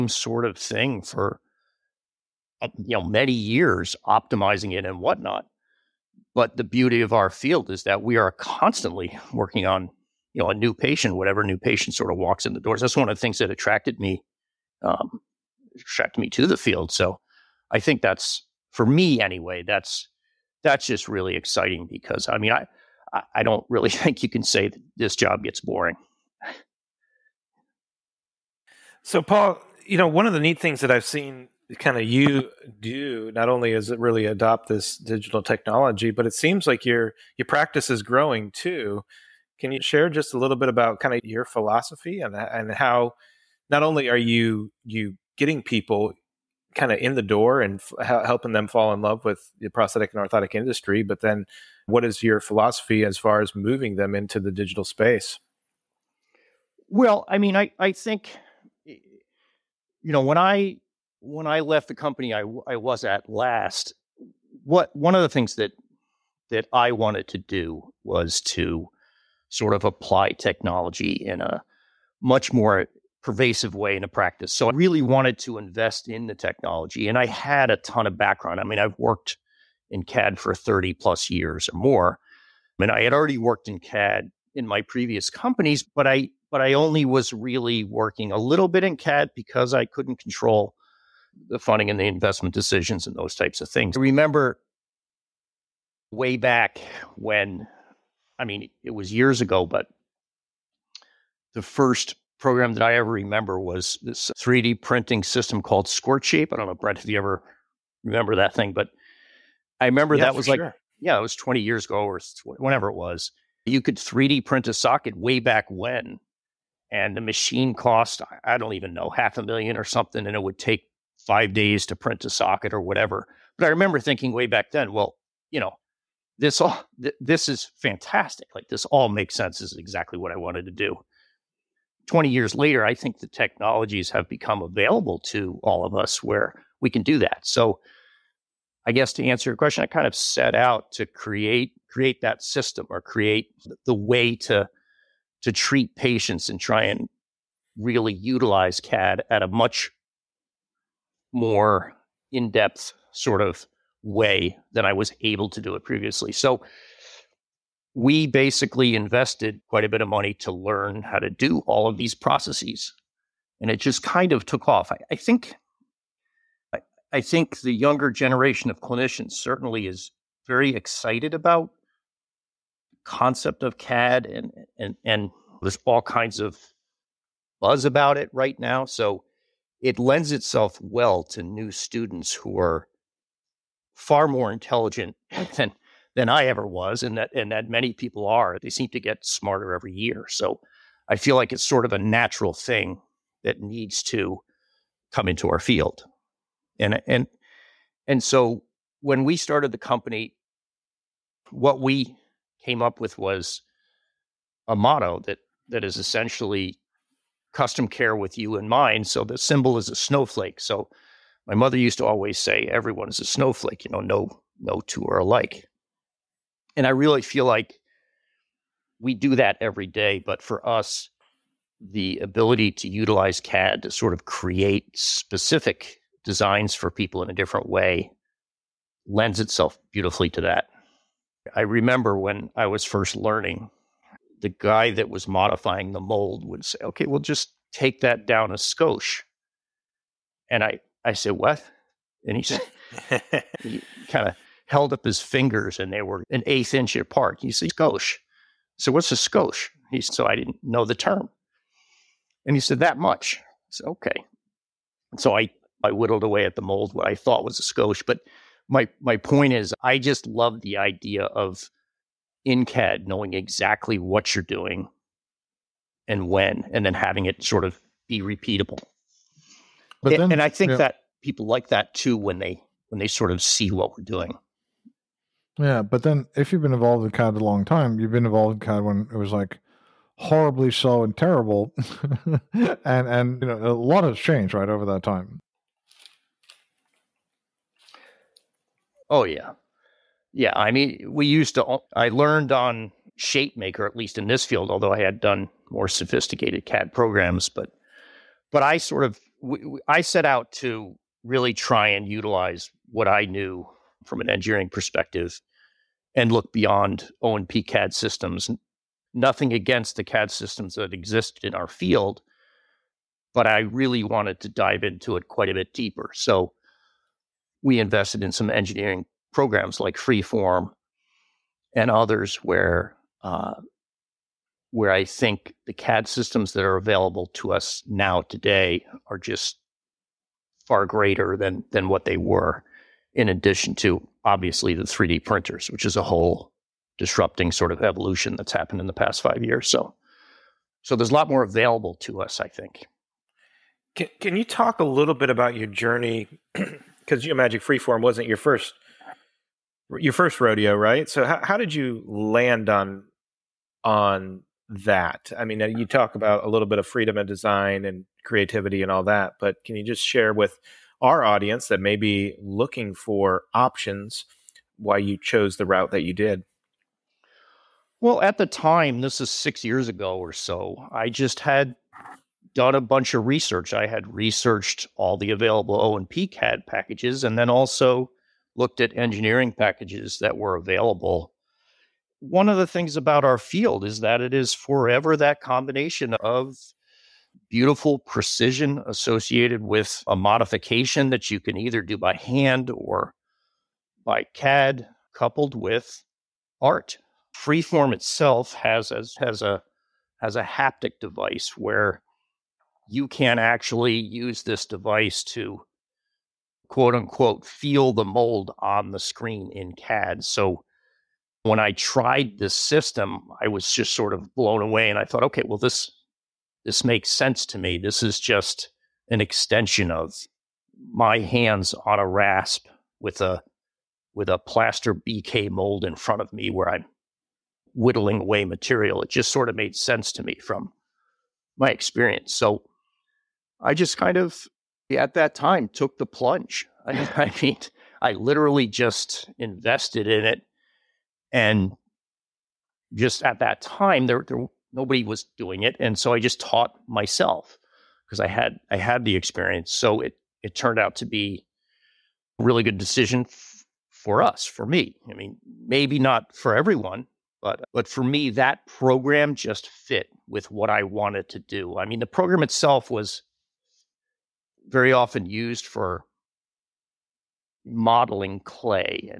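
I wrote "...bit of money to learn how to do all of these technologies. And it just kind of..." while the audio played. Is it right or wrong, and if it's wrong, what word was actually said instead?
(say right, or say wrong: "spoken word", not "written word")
wrong: "processes", not "technologies".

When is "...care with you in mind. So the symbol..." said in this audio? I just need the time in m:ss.
3:27.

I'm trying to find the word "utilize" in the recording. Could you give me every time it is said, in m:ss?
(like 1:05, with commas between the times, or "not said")
2:28, 3:42, 5:02.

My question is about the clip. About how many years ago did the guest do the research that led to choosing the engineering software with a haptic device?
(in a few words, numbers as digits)
6 years.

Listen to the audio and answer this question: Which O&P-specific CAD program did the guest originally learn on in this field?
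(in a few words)
ShapeMaker.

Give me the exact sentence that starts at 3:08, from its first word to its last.
They seem to get smarter every year.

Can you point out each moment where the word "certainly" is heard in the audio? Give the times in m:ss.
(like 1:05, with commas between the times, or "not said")
2:49.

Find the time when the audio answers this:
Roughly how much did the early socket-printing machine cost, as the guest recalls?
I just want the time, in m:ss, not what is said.
1:59.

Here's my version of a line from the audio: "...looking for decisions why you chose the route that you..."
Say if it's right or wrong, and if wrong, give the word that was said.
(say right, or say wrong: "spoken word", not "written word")
wrong: "options", not "decisions".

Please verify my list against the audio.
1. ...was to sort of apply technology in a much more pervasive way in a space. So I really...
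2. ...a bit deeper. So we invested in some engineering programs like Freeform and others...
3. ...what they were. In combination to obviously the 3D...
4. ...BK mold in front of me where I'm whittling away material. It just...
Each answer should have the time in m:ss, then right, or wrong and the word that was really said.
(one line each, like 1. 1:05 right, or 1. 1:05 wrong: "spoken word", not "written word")
1. 1:08 wrong: "practice", not "space"
2. 5:15 right
3. 5:31 wrong: "addition", not "combination"
4. 7:04 right.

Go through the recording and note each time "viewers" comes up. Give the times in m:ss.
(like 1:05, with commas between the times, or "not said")
not said.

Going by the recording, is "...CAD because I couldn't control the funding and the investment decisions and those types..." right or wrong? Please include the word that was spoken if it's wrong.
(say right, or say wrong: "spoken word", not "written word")
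right.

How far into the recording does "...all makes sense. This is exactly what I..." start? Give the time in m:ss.
2:08.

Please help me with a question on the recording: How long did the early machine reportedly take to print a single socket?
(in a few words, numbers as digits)
5 days.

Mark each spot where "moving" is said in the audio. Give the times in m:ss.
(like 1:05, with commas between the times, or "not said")
0:53.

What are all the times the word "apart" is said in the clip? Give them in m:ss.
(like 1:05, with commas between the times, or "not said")
4:06.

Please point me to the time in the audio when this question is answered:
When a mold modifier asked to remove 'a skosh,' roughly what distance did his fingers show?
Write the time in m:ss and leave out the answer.
4:06.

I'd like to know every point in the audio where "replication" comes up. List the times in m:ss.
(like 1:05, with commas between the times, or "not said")
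not said.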